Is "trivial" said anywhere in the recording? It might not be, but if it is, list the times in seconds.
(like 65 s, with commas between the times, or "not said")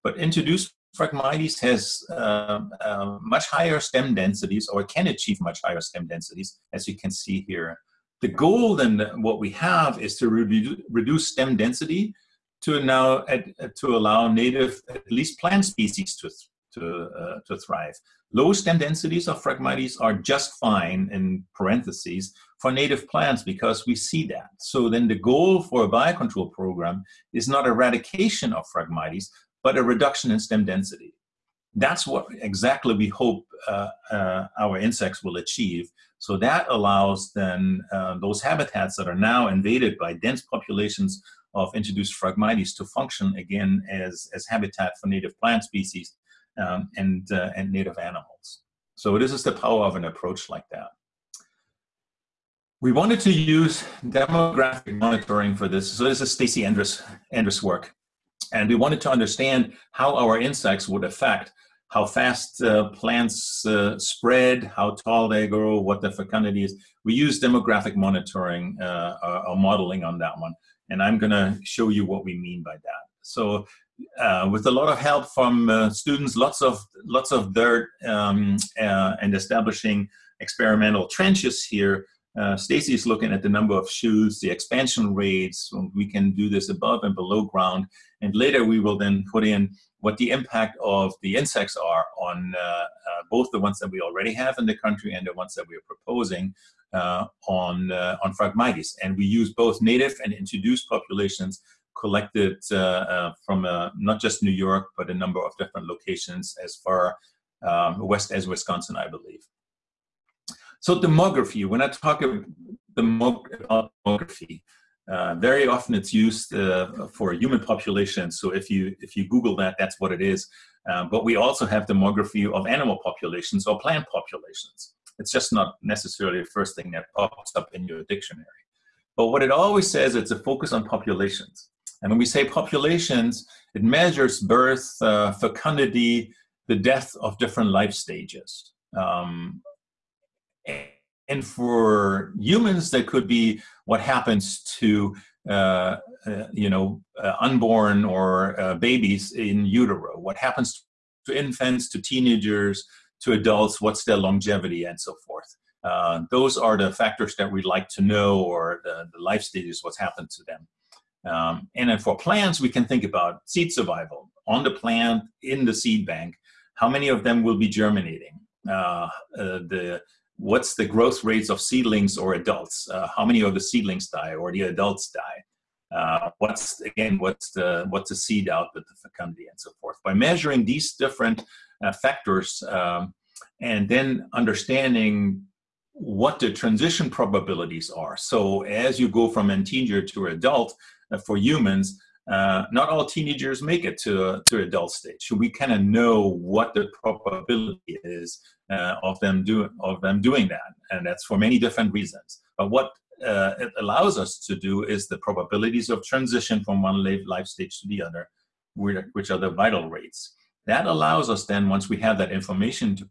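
not said.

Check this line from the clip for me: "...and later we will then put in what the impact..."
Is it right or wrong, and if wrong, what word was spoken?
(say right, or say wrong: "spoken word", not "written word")
right.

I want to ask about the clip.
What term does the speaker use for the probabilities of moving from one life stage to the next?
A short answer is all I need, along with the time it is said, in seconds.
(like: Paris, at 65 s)
Vital rates, at 209 s.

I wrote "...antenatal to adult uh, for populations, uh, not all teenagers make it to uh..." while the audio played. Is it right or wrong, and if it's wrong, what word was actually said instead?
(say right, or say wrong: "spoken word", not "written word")
wrong: "humans", not "populations".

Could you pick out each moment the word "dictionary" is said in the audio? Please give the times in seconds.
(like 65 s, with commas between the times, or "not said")
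128 s.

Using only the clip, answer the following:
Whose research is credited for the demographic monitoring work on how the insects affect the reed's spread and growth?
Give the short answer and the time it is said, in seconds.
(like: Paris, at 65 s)
Stacy Endriss, at 56 s.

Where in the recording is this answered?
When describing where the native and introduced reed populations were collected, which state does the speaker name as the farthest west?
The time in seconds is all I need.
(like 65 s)
108 s.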